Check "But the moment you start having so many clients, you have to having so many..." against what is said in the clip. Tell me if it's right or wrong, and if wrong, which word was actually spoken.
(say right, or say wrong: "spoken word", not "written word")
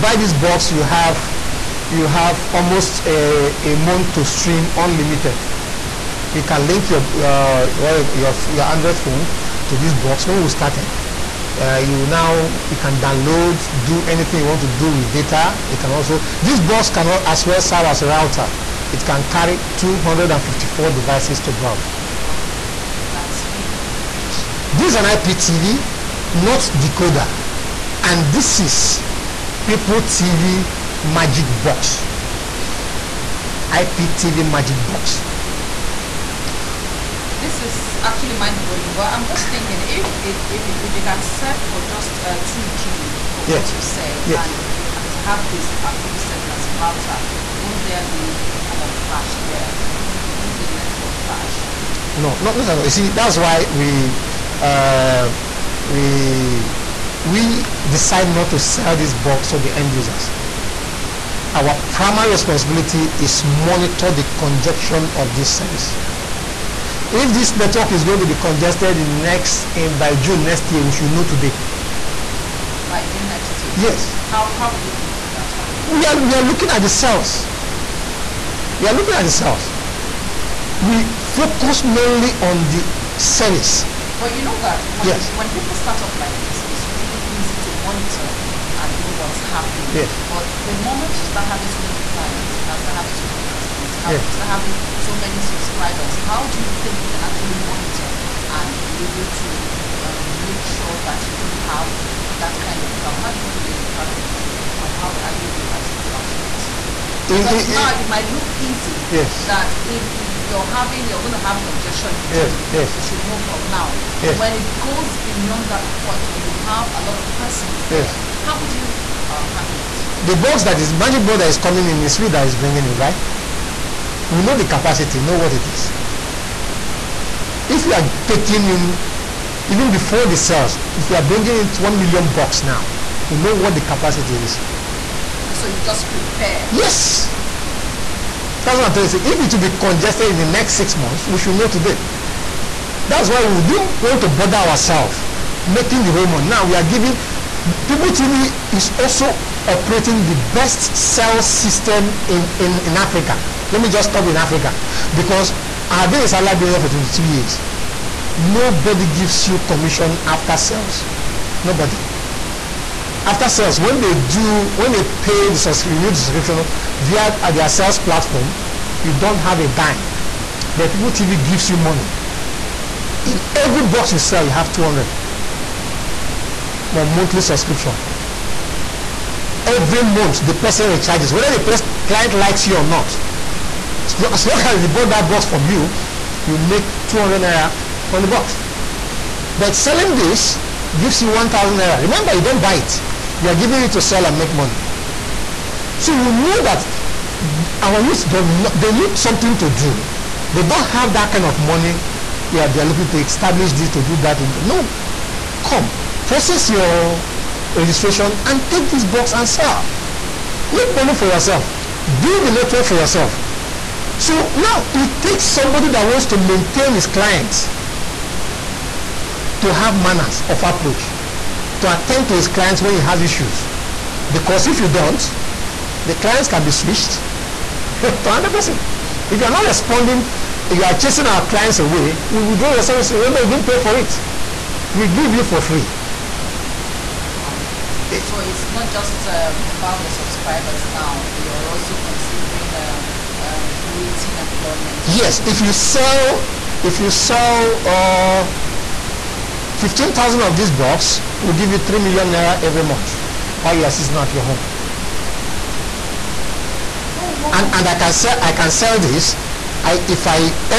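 right.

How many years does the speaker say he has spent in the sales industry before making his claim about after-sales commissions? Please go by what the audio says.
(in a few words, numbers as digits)
22 years.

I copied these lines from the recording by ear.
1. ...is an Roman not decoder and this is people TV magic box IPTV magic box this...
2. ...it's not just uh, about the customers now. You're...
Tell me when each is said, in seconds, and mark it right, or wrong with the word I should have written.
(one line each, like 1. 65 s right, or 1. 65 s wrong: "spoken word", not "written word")
1. 24 s wrong: "IPTV", not "Roman"
2. 238 s wrong: "subscribers", not "customers".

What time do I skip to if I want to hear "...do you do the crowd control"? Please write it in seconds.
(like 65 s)
103 s.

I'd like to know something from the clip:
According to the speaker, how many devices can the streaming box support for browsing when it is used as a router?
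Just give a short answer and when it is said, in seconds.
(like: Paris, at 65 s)
254, at 19 s.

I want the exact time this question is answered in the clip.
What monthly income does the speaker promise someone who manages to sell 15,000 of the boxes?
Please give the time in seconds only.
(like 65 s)
251 s.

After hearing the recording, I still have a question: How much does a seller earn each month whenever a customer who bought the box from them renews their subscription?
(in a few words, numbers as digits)
200 naira.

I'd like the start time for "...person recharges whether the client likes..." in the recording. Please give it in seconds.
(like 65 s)
180 s.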